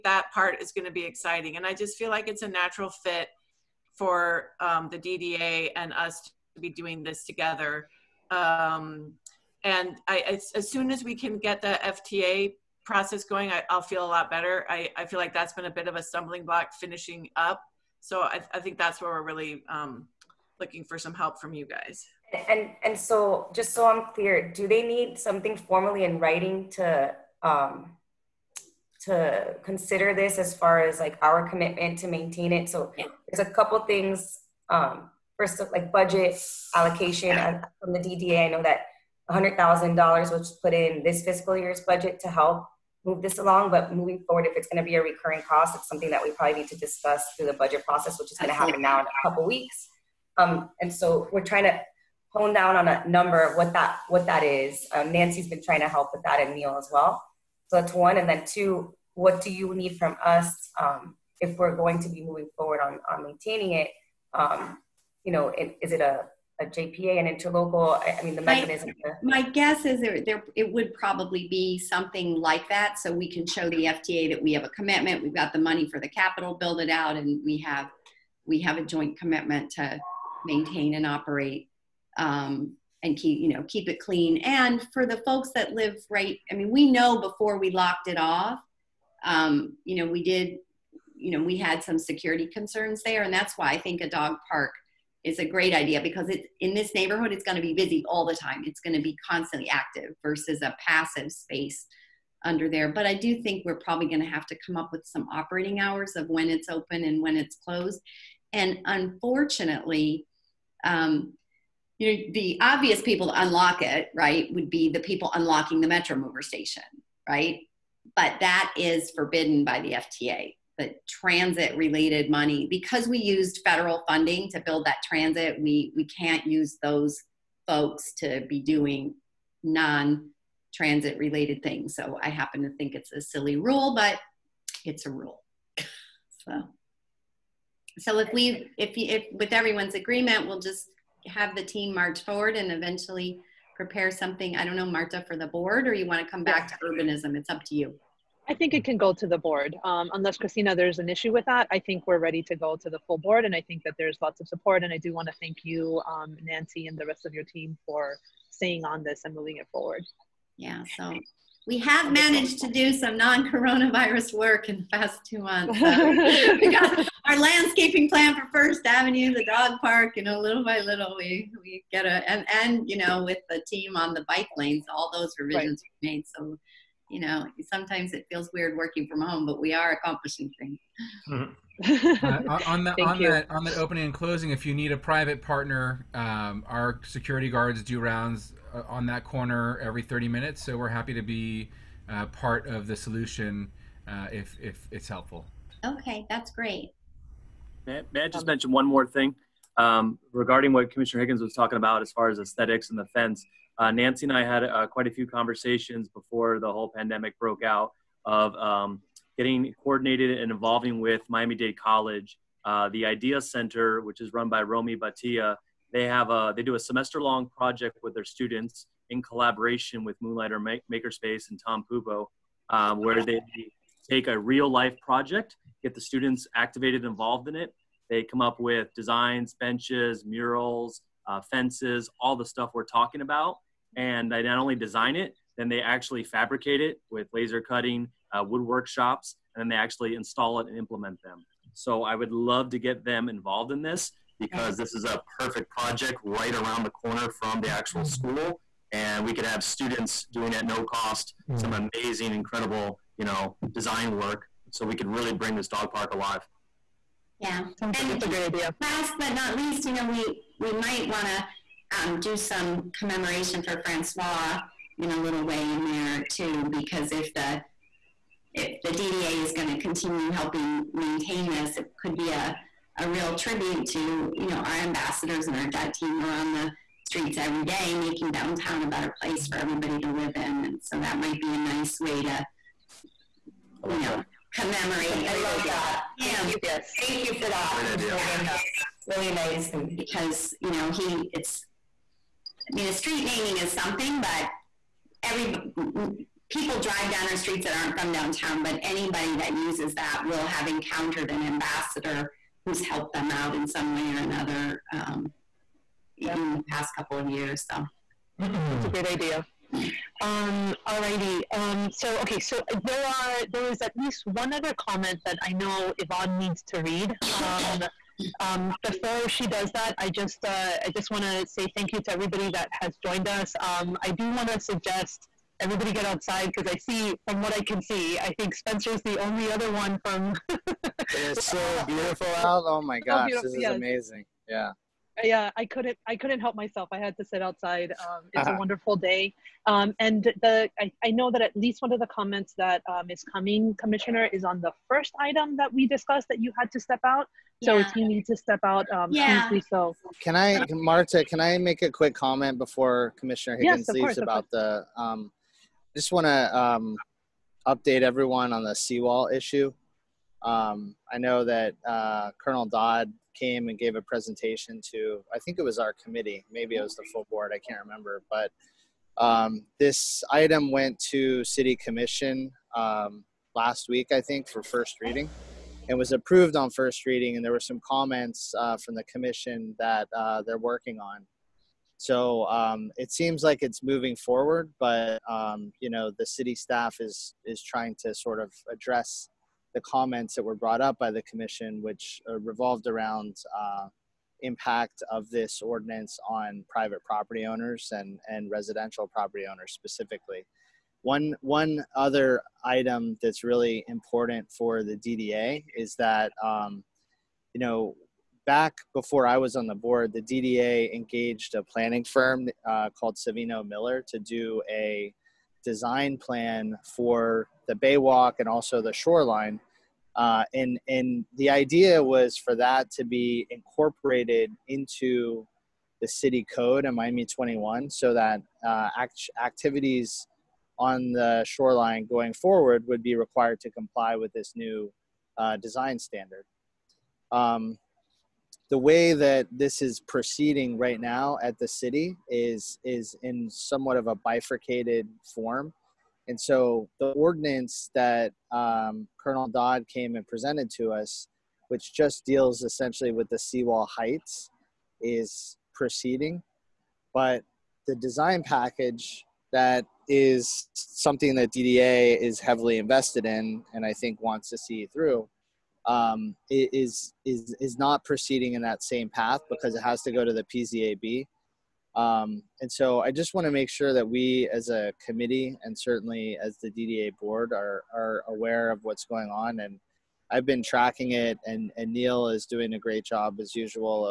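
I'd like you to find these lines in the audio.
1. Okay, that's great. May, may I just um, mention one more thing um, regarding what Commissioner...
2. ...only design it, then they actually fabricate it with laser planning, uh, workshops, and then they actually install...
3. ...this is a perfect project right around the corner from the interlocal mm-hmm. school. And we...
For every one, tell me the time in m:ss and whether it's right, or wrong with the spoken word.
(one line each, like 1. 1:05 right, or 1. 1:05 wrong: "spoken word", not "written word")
1. 3:15 right
2. 3:54 wrong: "cutting", not "planning"
3. 4:04 wrong: "actual", not "interlocal".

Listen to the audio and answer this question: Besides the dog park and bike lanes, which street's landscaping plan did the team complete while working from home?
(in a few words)
First Avenue.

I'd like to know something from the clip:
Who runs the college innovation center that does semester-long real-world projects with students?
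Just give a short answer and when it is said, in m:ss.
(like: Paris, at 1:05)
Romy Batia, at 3:34.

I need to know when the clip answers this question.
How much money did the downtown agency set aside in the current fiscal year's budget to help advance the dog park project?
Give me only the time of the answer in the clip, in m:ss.
0:39.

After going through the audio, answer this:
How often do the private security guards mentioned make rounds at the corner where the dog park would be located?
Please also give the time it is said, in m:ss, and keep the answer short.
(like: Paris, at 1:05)
every 30 minutes, at 3:09.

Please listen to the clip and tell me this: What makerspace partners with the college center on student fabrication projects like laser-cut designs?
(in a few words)
Moonlighter Makerspace.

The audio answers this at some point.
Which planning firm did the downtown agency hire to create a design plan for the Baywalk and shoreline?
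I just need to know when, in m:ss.
6:53.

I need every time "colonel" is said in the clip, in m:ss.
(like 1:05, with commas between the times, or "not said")
6:02, 7:29.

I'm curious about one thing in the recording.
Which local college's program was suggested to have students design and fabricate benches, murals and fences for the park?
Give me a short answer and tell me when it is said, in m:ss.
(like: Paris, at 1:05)
Miami Dade College, at 3:31.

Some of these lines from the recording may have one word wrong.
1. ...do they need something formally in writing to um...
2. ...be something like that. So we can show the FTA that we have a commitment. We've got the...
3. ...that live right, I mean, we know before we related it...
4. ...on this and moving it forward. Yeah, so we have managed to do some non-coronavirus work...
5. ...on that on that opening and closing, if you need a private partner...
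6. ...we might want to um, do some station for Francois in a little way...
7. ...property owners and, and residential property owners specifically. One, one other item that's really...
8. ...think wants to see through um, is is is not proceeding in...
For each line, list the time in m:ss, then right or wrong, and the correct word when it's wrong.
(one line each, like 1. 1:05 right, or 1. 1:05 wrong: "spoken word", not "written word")
1. 0:24 right
2. 1:11 right
3. 1:25 wrong: "locked", not "related"
4. 2:38 right
5. 3:03 right
6. 4:20 wrong: "commemoration", not "station"
7. 6:37 right
8. 7:43 right.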